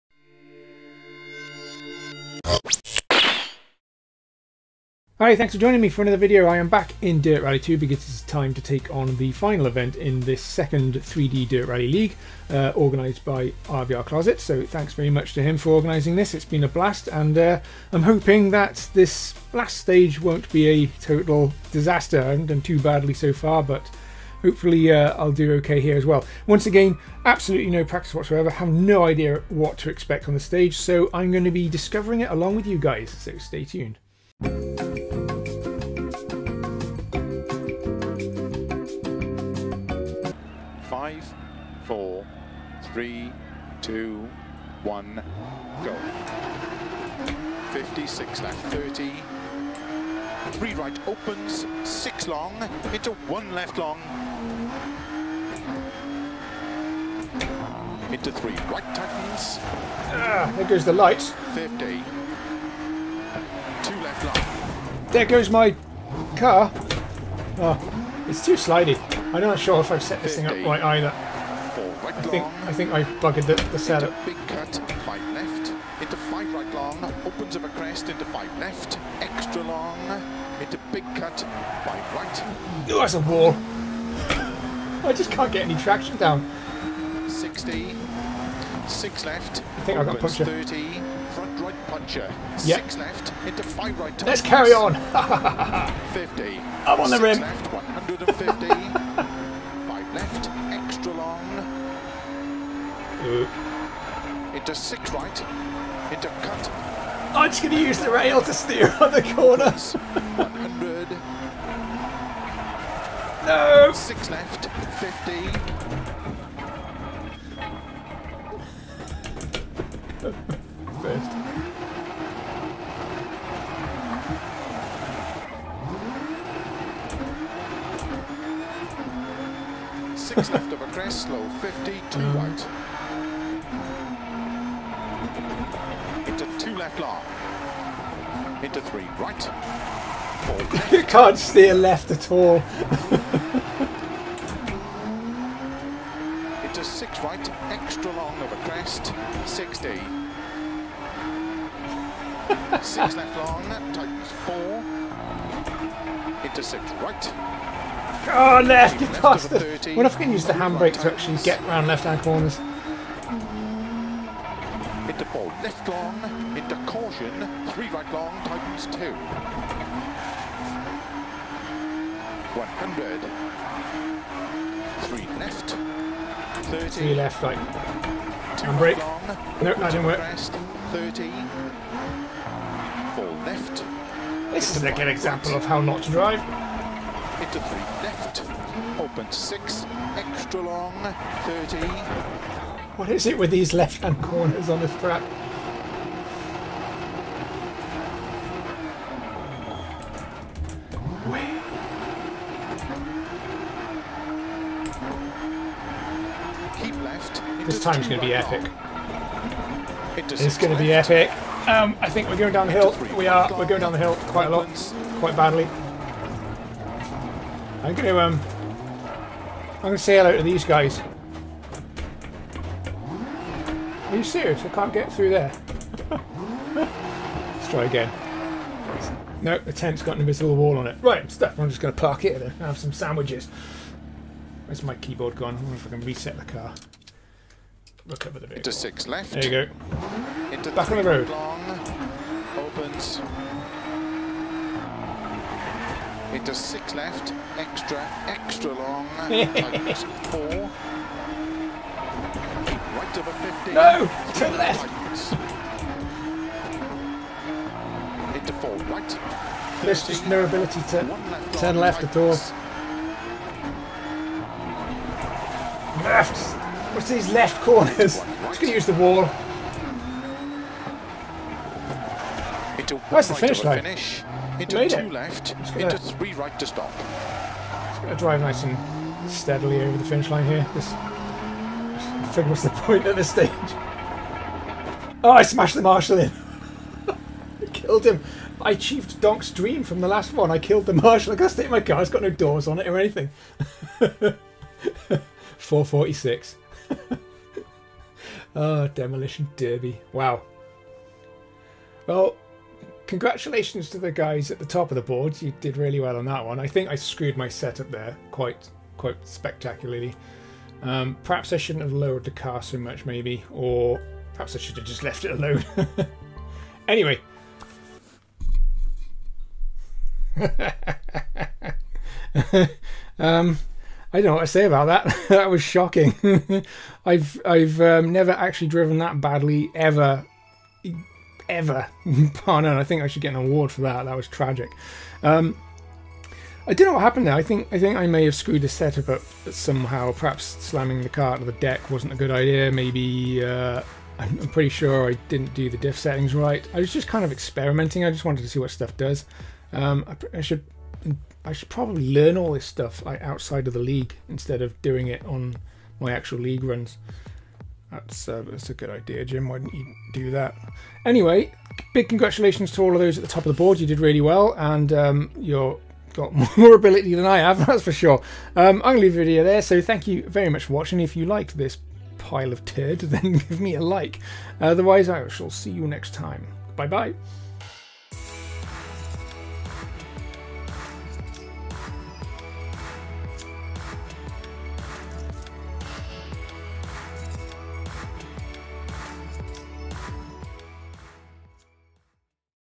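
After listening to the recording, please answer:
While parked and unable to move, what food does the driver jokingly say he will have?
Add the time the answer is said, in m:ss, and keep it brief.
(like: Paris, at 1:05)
Sandwiches, at 3:52.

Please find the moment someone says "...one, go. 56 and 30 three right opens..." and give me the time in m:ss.
0:44.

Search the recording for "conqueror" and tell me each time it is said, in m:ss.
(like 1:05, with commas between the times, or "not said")
not said.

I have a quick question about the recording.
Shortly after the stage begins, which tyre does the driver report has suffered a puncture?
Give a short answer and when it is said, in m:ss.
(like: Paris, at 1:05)
Front right, at 1:31.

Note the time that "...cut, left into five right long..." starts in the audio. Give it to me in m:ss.
1:14.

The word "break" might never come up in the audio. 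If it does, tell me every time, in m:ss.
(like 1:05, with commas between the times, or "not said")
2:58.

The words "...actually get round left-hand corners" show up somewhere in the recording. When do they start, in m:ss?
2:41.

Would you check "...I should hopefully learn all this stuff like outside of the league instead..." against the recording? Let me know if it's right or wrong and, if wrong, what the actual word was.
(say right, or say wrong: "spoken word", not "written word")
wrong: "probably", not "hopefully".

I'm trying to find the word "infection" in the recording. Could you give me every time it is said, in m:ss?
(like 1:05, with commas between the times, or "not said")
not said.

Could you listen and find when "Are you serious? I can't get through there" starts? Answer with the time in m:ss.
3:44.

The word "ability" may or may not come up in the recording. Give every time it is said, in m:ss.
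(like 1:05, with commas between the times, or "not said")
4:20, 6:06.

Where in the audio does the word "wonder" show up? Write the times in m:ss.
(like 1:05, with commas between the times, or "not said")
3:55.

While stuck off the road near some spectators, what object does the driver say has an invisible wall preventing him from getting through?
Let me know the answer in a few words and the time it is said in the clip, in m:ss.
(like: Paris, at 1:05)
The tent, at 3:49.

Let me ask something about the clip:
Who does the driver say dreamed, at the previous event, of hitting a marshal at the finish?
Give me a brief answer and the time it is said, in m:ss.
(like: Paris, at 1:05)
Donk, at 4:49.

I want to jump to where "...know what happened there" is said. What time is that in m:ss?
5:36.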